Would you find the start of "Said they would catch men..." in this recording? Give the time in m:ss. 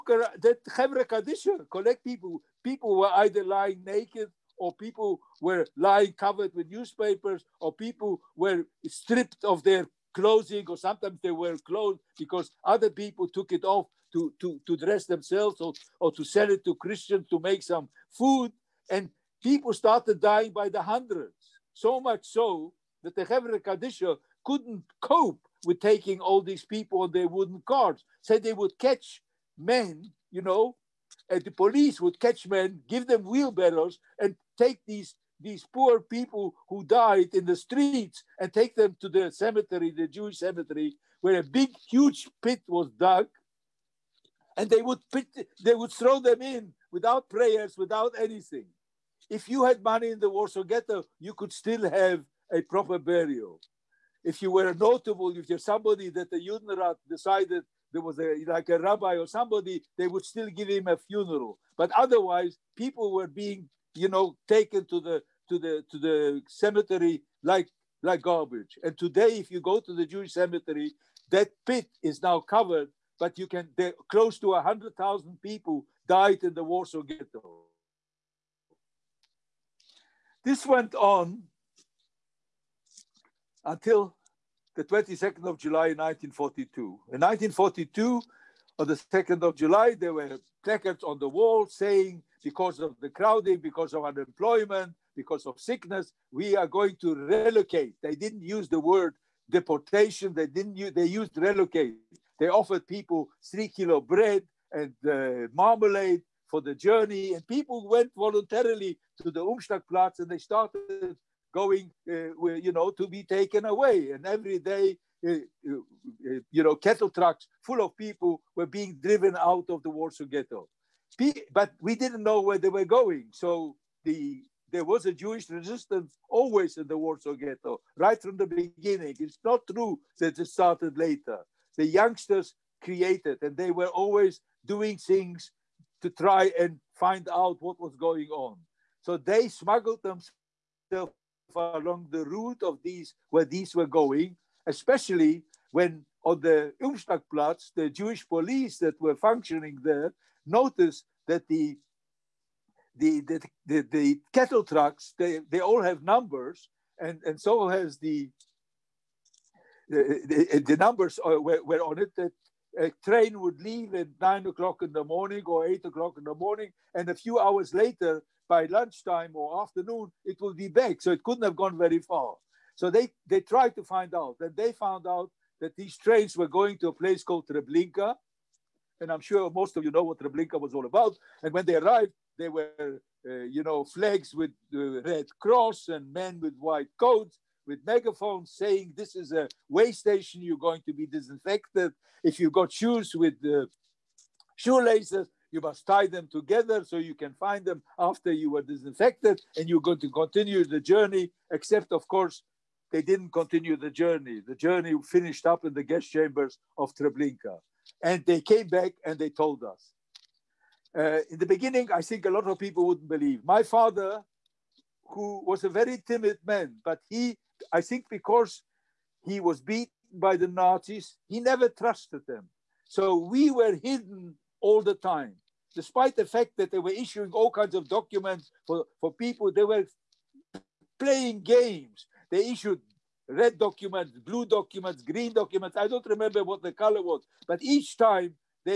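0:28.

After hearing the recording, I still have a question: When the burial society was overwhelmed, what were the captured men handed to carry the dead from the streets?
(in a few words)
wheelbarrows.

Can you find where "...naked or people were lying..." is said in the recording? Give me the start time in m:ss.
0:03.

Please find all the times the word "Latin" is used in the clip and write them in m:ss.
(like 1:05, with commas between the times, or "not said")
not said.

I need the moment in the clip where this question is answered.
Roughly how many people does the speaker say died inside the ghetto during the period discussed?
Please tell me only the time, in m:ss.
1:14.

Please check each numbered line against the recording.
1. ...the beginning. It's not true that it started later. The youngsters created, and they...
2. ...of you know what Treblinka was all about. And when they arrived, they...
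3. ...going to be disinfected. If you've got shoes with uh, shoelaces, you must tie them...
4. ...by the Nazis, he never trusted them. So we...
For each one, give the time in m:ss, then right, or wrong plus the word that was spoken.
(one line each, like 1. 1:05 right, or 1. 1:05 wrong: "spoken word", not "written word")
1. 2:08 right
2. 2:59 right
3. 3:10 right
4. 3:40 right.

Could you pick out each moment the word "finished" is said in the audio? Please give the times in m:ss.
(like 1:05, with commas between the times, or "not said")
3:25.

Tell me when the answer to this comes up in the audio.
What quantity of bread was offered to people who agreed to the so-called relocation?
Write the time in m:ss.
1:43.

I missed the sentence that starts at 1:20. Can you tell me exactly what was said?
This went on until the 22nd of July 1942.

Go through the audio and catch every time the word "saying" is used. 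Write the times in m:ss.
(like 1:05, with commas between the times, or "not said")
1:31, 3:08.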